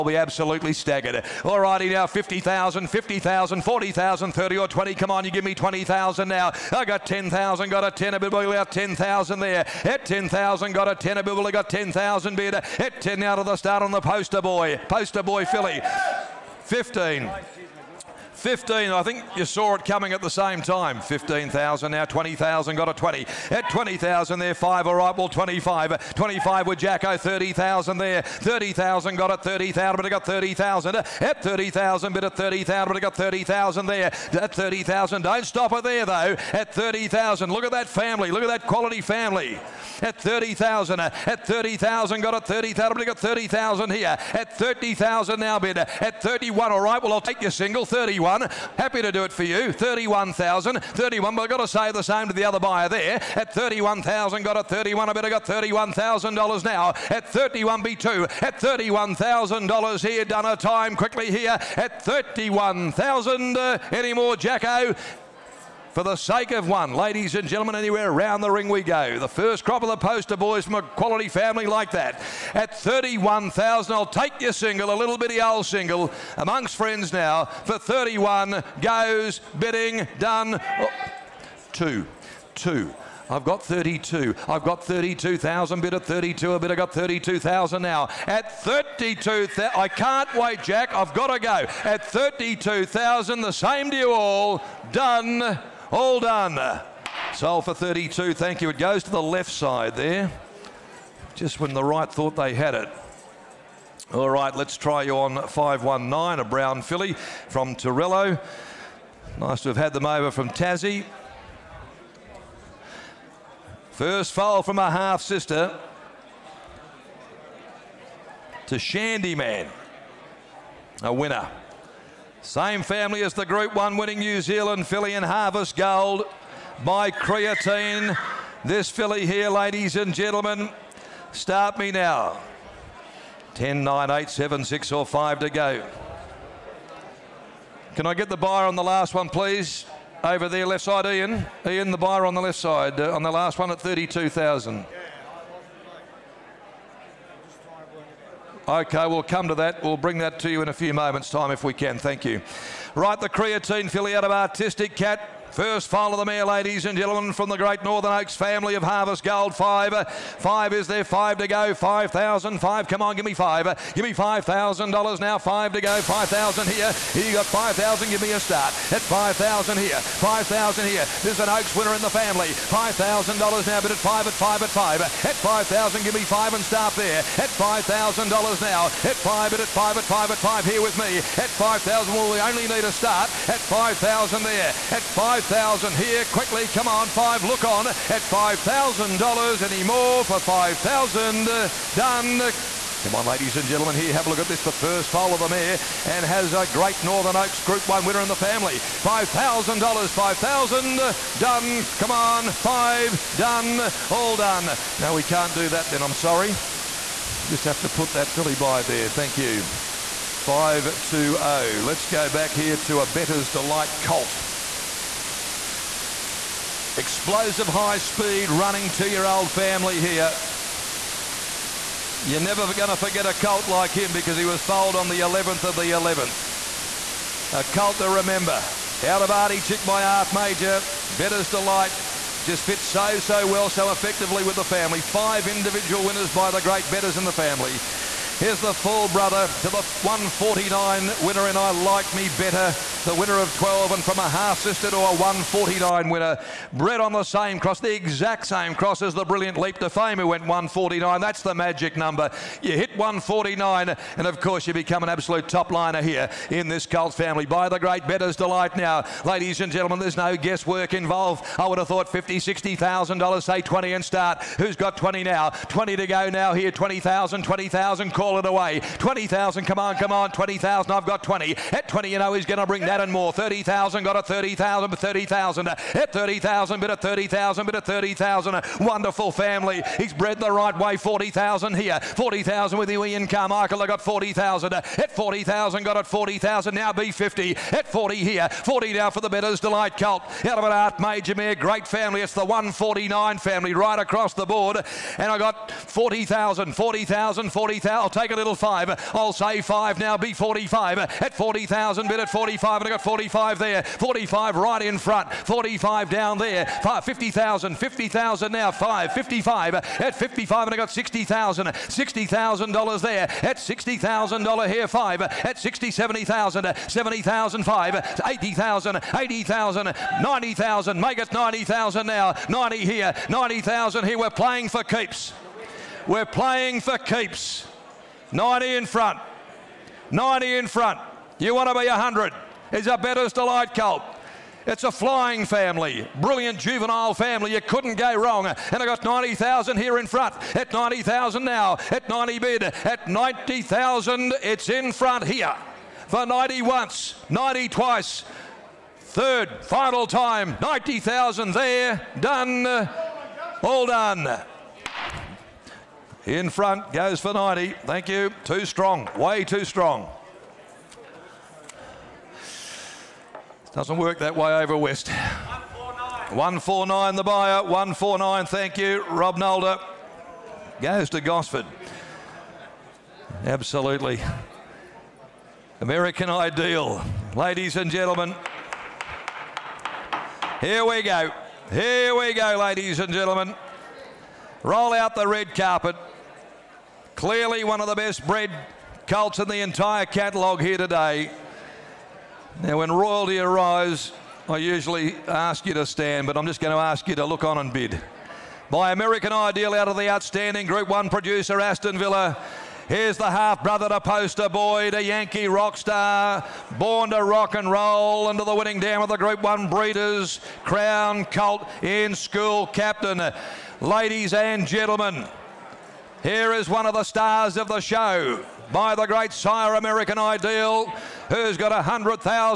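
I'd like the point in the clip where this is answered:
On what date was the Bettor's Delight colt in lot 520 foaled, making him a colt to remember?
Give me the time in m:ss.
3:45.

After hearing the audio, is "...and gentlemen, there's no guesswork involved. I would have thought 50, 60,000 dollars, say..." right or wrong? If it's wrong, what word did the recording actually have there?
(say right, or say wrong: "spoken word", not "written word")
right.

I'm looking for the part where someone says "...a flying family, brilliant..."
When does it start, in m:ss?
5:34.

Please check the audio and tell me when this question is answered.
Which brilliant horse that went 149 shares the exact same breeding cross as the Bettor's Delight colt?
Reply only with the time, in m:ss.
4:09.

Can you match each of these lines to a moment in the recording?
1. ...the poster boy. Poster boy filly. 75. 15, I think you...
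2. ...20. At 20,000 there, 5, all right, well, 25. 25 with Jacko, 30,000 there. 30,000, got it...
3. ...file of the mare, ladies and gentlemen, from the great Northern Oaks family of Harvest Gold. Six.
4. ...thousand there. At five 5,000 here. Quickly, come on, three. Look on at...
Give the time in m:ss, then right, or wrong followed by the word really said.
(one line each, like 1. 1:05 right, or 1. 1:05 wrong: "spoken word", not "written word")
1. 0:13 wrong: "15", not "75"
2. 0:22 right
3. 2:35 wrong: "Five", not "Six"
4. 3:03 wrong: "five", not "three".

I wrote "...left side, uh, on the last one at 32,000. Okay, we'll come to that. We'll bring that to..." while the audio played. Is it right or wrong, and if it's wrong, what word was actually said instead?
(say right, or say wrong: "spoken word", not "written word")
right.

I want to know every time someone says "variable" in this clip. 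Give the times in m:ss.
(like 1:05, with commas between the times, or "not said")
not said.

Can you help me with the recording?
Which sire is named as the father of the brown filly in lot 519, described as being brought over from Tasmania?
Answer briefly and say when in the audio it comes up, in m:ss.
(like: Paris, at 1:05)
Torello, at 1:47.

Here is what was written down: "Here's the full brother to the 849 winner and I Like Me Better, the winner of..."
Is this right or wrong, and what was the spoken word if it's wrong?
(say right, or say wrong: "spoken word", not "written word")
wrong: "149", not "849".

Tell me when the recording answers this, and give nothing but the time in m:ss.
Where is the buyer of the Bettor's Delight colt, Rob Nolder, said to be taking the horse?
6:11.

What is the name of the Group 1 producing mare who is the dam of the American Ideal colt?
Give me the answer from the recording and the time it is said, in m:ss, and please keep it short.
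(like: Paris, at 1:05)
Aston Villa, at 6:41.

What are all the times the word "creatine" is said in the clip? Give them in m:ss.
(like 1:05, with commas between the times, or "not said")
2:07, 2:33.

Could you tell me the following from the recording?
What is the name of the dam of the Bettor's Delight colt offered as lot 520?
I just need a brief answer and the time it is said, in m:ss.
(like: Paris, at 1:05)
Artie Chick, at 3:49.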